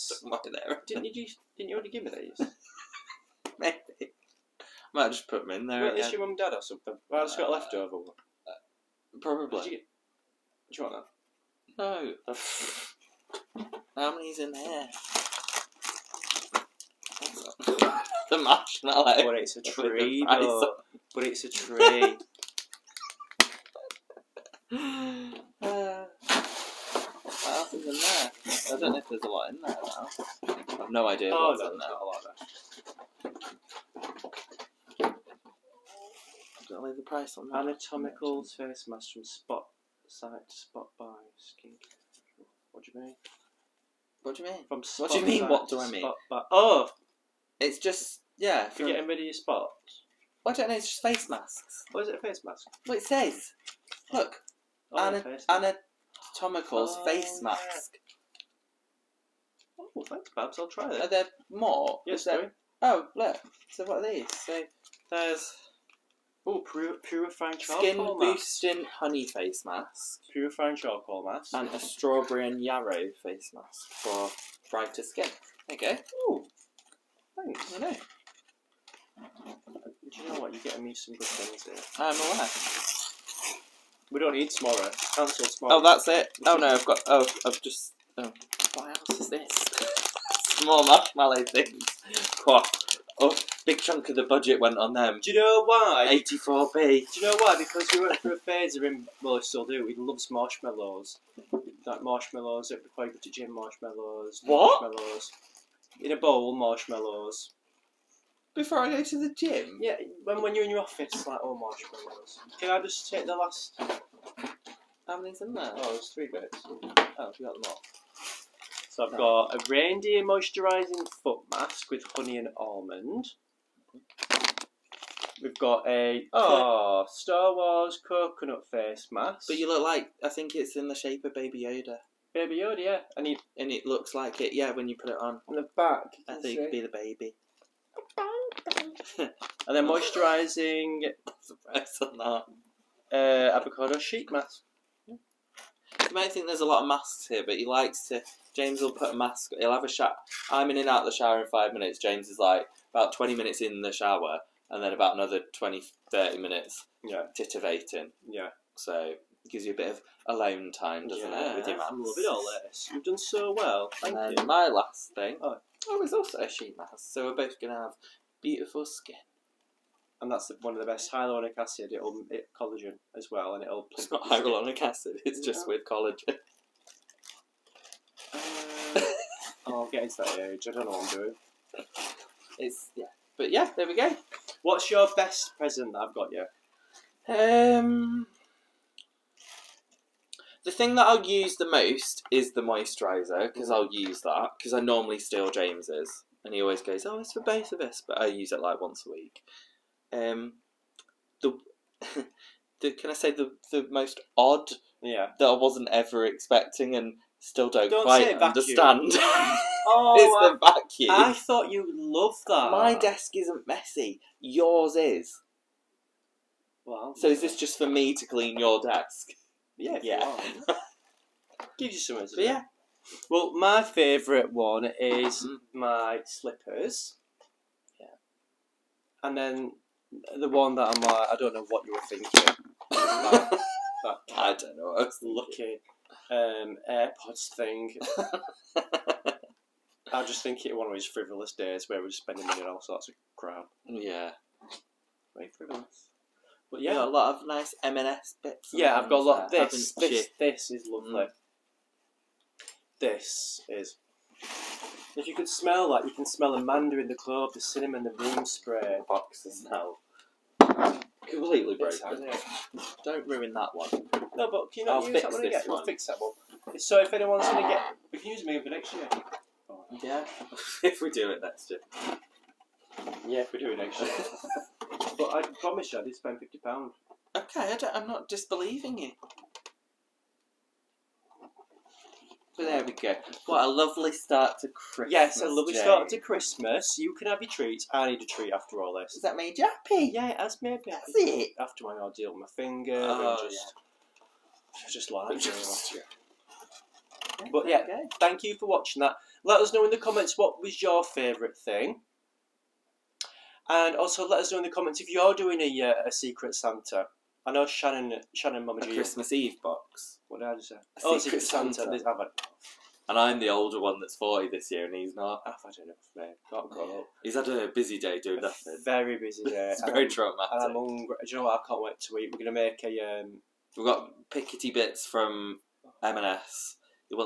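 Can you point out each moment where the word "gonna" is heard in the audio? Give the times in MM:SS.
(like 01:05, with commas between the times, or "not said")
02:47, 05:22.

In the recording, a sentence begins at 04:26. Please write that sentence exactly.
So if anyone's going to get...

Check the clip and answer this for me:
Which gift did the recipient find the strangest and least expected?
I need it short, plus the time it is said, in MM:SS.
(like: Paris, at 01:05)
The vacuum, at 03:30.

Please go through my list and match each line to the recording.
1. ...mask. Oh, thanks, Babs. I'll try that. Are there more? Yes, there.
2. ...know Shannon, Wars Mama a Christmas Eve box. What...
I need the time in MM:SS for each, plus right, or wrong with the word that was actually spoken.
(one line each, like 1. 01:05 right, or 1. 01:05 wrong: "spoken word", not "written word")
1. 00:57 right
2. 05:07 wrong: "Shannon", not "Wars".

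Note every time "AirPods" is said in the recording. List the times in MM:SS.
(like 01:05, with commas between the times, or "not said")
03:56.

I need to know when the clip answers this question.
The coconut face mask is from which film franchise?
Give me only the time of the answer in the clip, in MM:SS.
02:07.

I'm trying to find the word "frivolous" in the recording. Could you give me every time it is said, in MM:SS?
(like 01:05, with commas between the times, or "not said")
04:01, 04:05.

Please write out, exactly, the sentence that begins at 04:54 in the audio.
just like just, But yeah, okay.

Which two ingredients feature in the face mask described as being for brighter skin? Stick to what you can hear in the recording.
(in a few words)
Strawberry and yarrow.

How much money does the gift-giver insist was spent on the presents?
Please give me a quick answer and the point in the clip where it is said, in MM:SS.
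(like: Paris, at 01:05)
£50, at 04:36.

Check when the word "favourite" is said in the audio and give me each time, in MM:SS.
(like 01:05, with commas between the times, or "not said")
03:43, 05:01.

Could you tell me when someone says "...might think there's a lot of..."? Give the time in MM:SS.
02:26.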